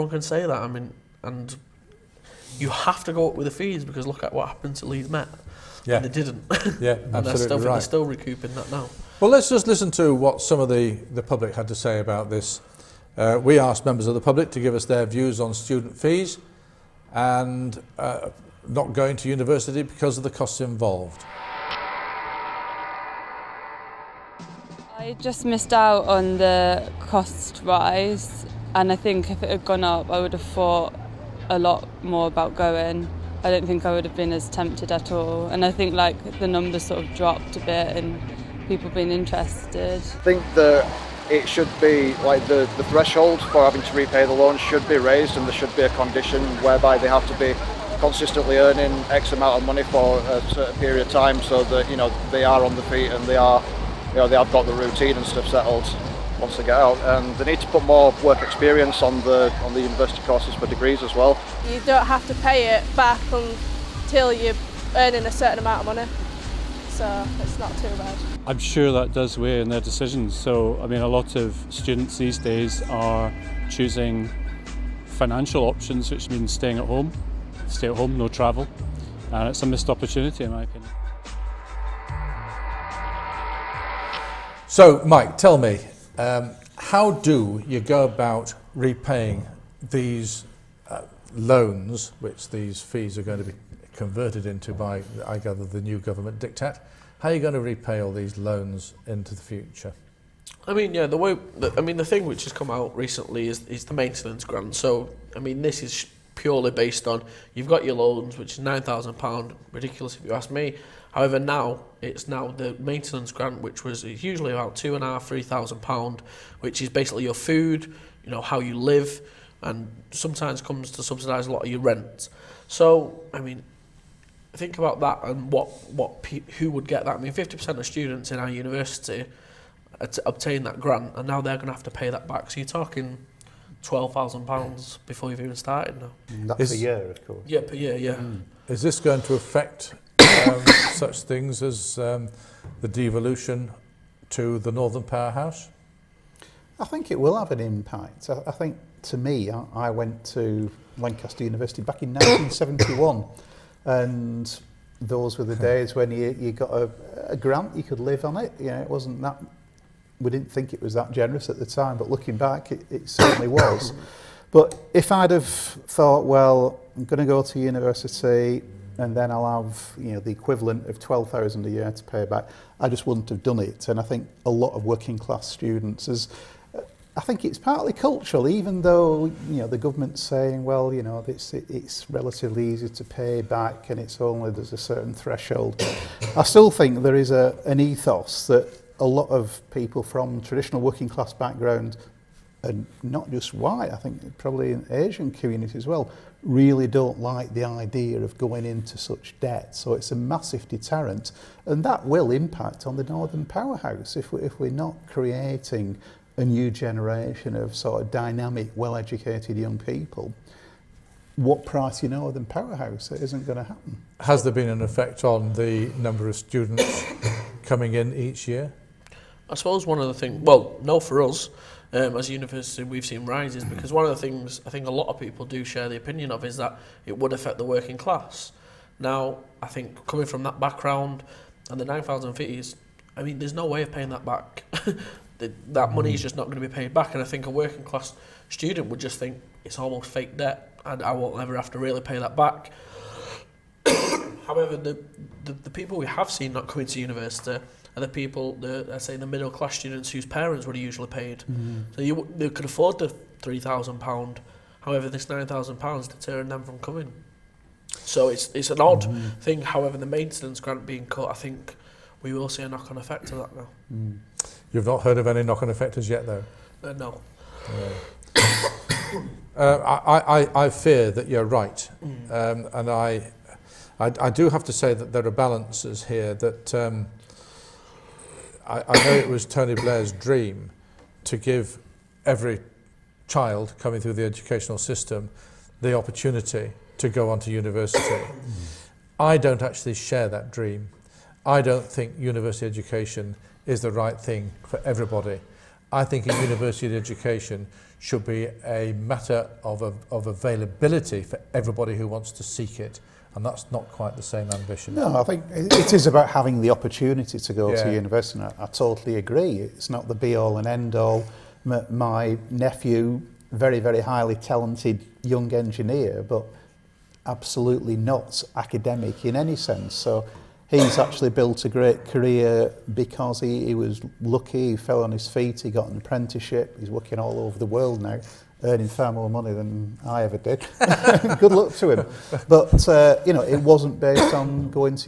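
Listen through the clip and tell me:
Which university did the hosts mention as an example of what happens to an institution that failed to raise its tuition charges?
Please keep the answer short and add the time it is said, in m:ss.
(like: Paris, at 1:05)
Leeds Met, at 0:04.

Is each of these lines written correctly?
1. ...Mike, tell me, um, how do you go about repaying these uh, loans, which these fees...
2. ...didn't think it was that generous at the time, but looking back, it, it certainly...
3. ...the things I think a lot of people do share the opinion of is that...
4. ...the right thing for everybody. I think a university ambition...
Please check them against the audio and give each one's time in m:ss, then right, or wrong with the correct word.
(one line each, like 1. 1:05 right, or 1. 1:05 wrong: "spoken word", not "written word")
1. 1:25 right
2. 2:40 right
3. 3:44 right
4. 4:53 wrong: "education", not "ambition".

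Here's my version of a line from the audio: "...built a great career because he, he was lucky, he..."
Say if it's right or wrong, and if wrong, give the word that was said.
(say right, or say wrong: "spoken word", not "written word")
right.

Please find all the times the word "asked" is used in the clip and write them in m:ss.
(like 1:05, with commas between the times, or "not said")
0:13.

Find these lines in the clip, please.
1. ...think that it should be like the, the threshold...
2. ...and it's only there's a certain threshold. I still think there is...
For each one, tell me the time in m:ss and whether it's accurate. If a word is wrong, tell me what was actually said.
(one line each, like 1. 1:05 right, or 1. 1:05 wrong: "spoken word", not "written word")
1. 0:40 right
2. 3:03 right.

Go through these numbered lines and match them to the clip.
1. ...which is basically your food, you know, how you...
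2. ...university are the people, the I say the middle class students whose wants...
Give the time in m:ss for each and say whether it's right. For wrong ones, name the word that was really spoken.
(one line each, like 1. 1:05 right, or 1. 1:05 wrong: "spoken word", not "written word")
1. 1:56 right
2. 4:06 wrong: "parents", not "wants".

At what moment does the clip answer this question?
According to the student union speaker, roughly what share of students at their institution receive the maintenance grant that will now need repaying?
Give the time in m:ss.
2:07.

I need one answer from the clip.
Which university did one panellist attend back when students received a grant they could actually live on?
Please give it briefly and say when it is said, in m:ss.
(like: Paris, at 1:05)
Lancaster University, at 2:30.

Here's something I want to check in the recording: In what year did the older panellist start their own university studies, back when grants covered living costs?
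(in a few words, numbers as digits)
1971.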